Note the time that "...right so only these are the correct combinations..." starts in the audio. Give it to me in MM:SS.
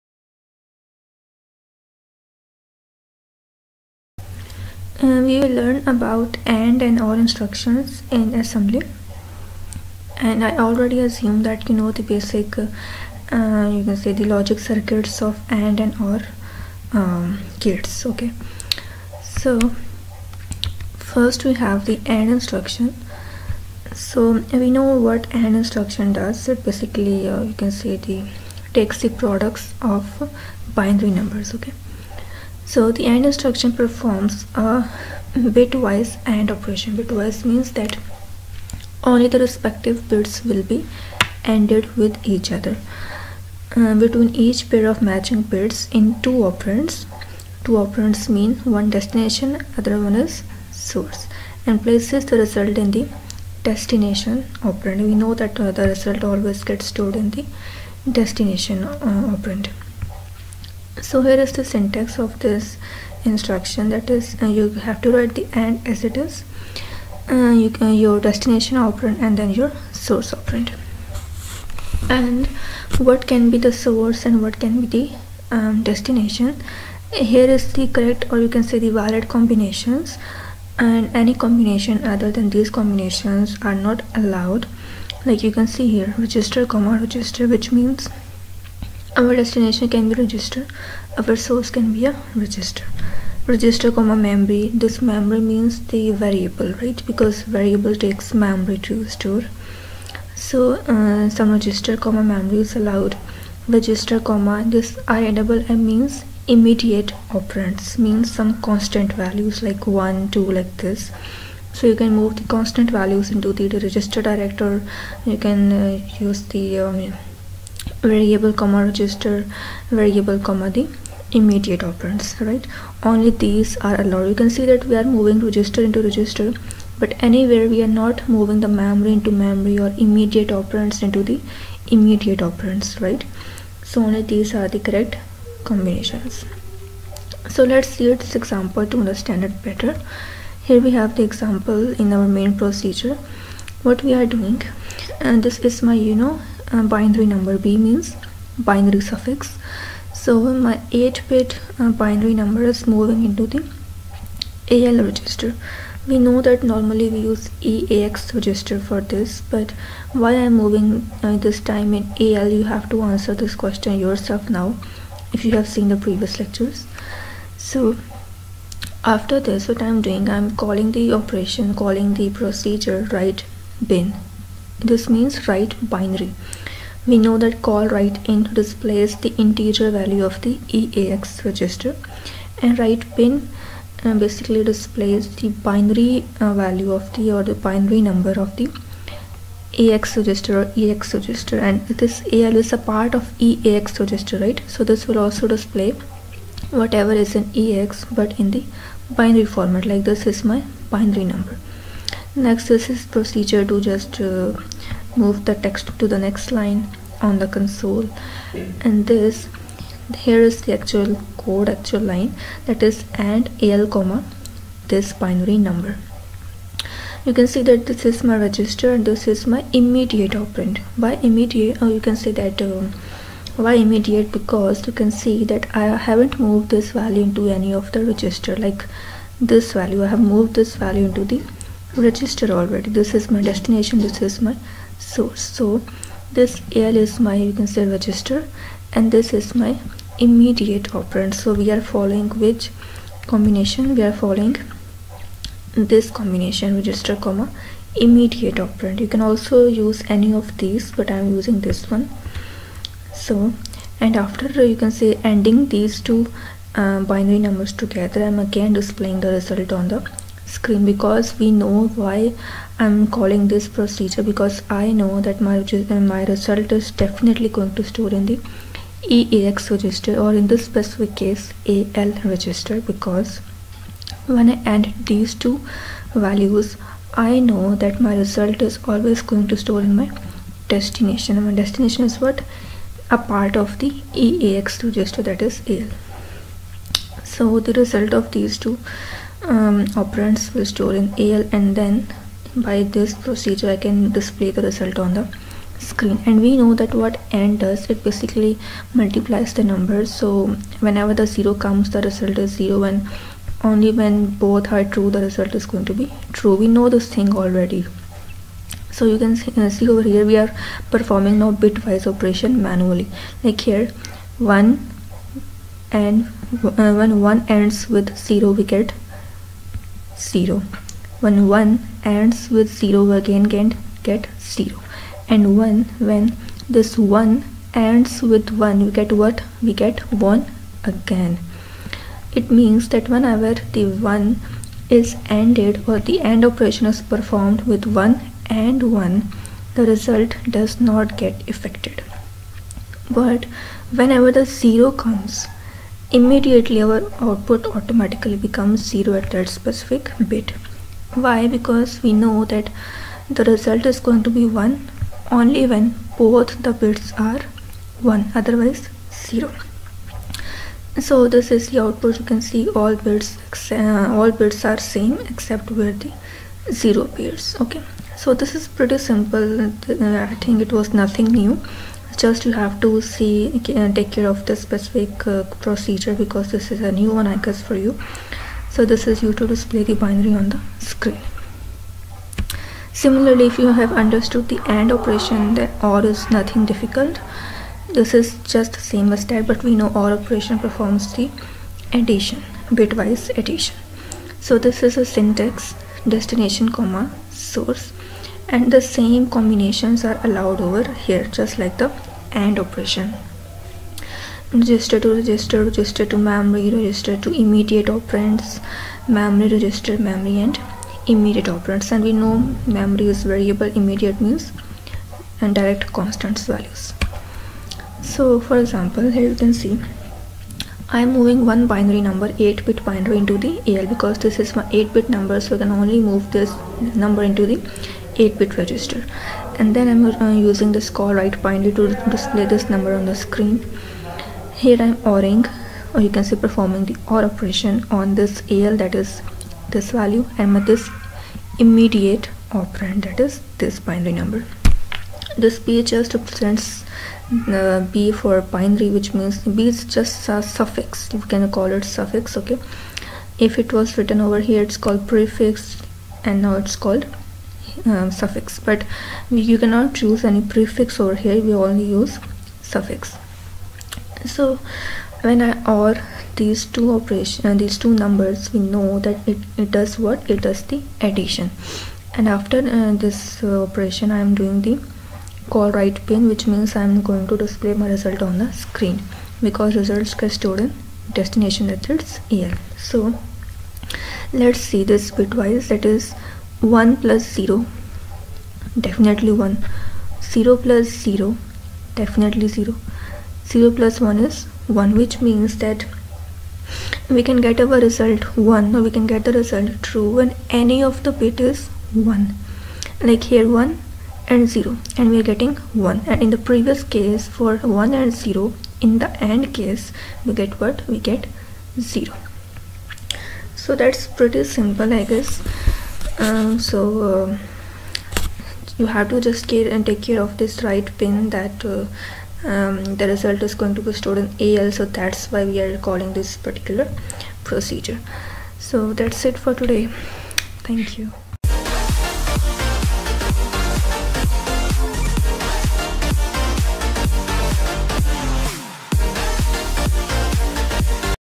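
02:13.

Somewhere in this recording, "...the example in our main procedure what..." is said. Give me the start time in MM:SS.
02:21.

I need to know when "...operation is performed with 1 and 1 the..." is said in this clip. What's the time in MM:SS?
05:36.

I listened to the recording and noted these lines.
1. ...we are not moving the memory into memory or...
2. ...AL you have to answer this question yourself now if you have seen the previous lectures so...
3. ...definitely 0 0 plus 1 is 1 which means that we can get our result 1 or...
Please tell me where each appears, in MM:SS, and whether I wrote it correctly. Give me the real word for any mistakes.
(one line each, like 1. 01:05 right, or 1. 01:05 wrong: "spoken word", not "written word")
1. 02:07 right
2. 02:42 right
3. 08:11 right.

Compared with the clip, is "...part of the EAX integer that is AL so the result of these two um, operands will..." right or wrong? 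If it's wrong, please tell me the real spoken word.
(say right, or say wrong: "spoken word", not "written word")
wrong: "register", not "integer".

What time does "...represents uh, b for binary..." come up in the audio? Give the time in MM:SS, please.
07:26.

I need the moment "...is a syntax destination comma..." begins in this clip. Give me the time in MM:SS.
06:34.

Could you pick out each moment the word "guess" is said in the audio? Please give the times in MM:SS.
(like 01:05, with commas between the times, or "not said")
06:17, 08:35.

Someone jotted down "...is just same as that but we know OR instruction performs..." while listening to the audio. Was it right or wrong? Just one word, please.
wrong.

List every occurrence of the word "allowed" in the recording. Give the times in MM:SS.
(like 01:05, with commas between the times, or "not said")
01:24, 01:42, 02:04, 06:40.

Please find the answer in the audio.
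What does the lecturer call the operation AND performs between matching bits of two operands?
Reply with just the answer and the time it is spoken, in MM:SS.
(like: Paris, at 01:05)
bitwise AND, at 00:35.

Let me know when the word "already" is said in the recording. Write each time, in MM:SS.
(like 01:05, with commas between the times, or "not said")
00:10, 03:52, 05:07.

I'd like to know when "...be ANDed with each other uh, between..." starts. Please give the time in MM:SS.
00:40.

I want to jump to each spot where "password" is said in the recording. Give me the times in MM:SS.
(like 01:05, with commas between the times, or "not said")
not said.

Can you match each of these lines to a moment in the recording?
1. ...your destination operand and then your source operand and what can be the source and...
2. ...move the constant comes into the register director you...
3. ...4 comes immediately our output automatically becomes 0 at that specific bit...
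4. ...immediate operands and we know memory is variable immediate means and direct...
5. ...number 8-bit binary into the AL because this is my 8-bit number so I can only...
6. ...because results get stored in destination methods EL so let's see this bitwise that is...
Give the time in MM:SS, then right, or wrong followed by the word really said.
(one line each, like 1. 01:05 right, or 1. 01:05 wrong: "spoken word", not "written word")
1. 01:07 right
2. 01:52 wrong: "values", not "comes"
3. 05:44 wrong: "0", not "4"
4. 06:51 right
5. 07:02 right
6. 07:59 right.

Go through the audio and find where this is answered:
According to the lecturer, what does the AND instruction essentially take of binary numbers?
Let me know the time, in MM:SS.
00:28.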